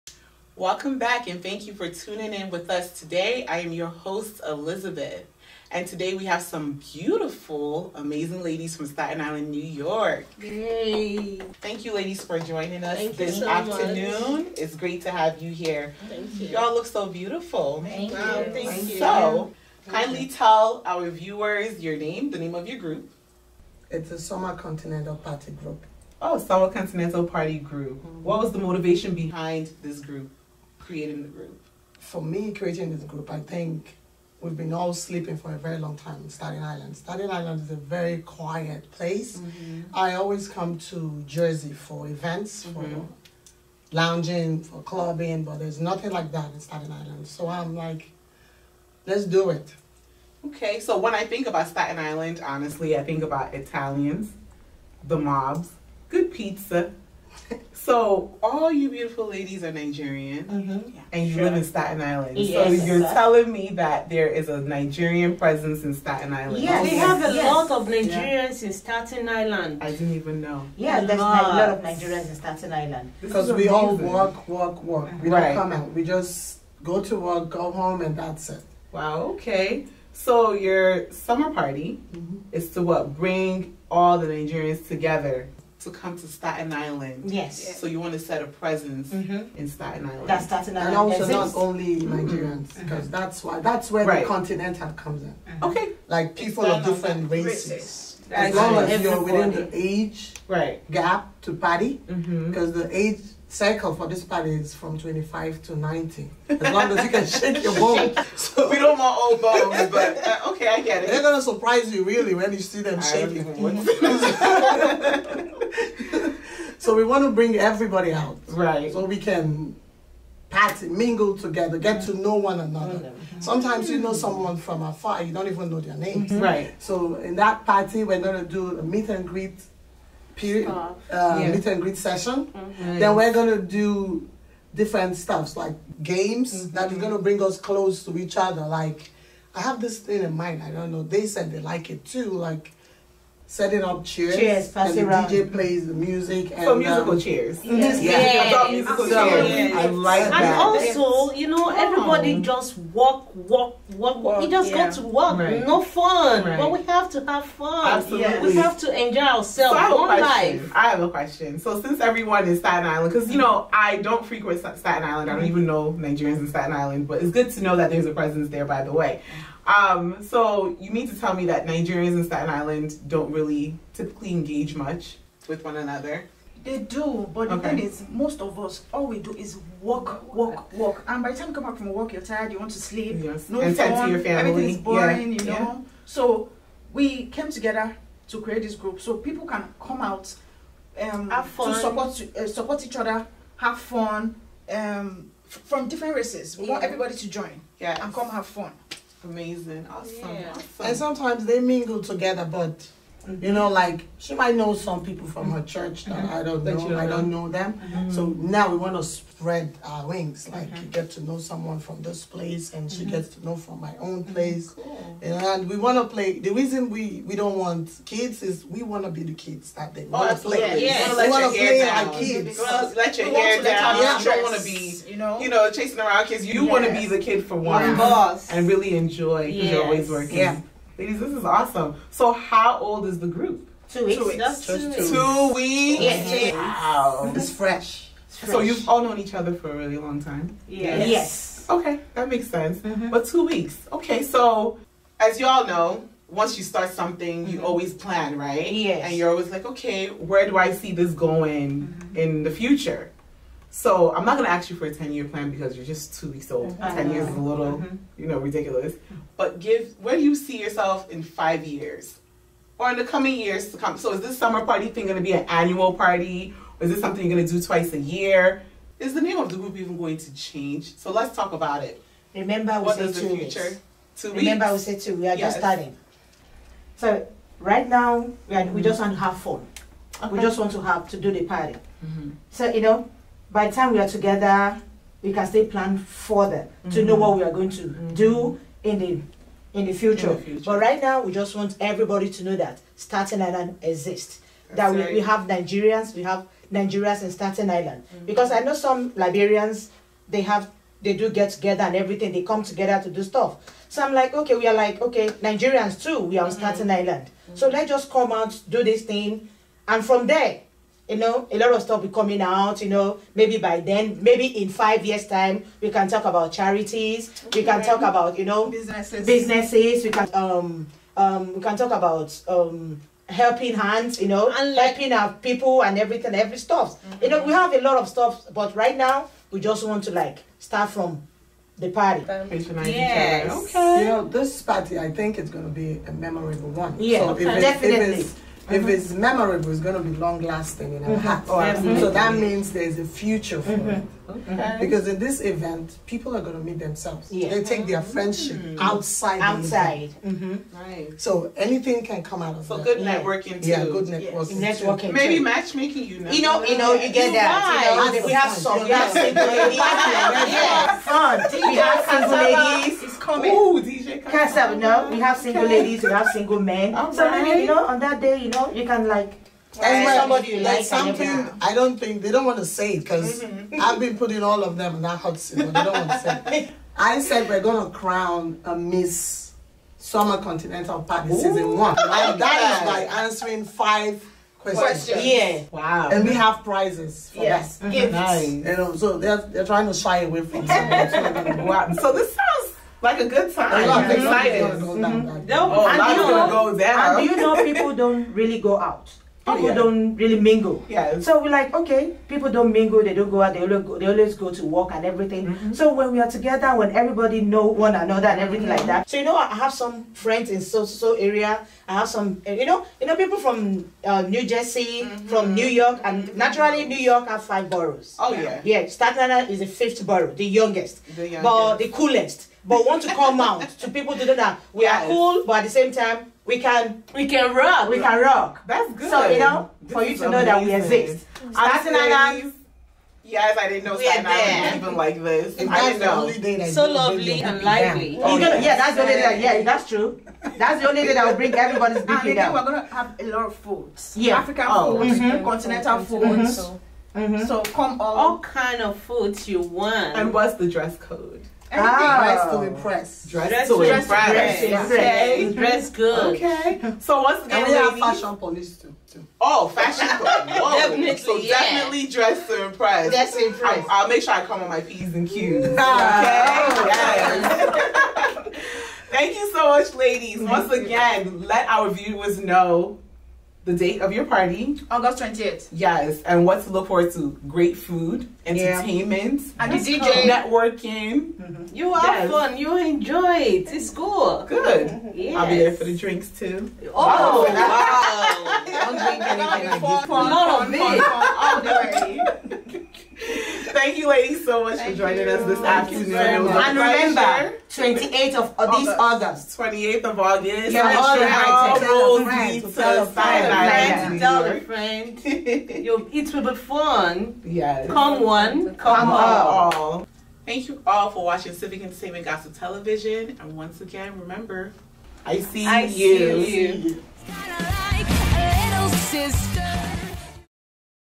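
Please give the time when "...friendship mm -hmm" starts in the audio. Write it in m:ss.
5:48.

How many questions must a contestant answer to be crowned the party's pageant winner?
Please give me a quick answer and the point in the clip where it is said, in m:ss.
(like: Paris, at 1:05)
5, at 6:22.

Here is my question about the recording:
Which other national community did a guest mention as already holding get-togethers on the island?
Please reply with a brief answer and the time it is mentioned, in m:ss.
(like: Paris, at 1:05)
Liberians, at 4:58.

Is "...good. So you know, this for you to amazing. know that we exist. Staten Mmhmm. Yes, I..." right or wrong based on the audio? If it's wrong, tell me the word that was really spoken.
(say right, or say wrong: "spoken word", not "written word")
wrong: "Island", not "Mmhmm".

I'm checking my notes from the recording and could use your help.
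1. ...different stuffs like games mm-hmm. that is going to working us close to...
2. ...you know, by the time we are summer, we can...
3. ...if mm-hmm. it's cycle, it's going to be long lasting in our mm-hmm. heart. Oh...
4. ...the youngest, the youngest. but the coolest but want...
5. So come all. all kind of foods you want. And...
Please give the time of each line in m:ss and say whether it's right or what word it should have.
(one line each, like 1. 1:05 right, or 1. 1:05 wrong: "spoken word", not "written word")
1. 2:14 wrong: "bring", not "working"
2. 4:42 wrong: "together", not "summer"
3. 5:38 wrong: "memorable", not "cycle"
4. 7:00 right
5. 7:27 right.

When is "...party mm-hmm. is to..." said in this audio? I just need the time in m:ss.
1:21.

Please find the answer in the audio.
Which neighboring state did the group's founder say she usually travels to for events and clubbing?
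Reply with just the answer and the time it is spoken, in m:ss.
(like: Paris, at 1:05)
New Jersey, at 0:39.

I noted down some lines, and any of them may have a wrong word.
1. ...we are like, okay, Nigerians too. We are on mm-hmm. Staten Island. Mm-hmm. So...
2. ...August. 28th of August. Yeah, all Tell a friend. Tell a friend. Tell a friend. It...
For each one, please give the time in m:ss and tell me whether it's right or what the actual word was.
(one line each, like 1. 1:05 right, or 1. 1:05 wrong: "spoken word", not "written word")
1. 5:04 right
2. 8:18 right.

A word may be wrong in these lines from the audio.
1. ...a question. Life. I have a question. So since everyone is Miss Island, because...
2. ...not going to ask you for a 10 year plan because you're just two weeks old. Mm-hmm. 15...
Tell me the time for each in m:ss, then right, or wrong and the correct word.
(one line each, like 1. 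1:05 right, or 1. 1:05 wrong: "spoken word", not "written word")
1. 2:39 wrong: "Staten", not "Miss"
2. 4:14 wrong: "10", not "15".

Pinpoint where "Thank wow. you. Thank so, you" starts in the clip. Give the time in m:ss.
0:17.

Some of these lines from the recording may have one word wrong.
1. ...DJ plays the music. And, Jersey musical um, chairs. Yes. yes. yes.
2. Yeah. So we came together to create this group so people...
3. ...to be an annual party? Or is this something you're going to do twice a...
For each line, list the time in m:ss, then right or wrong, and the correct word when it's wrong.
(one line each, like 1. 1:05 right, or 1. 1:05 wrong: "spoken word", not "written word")
1. 2:25 wrong: "For", not "Jersey"
2. 3:05 right
3. 4:25 right.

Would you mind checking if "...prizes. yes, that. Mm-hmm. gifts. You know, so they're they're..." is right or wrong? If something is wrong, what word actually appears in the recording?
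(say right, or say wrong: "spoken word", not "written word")
right.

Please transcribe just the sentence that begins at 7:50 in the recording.
Once again, let our viewers know the date of your party.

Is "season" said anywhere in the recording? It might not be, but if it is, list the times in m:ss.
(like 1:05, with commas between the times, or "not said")
6:21.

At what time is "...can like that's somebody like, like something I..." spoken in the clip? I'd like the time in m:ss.
6:08.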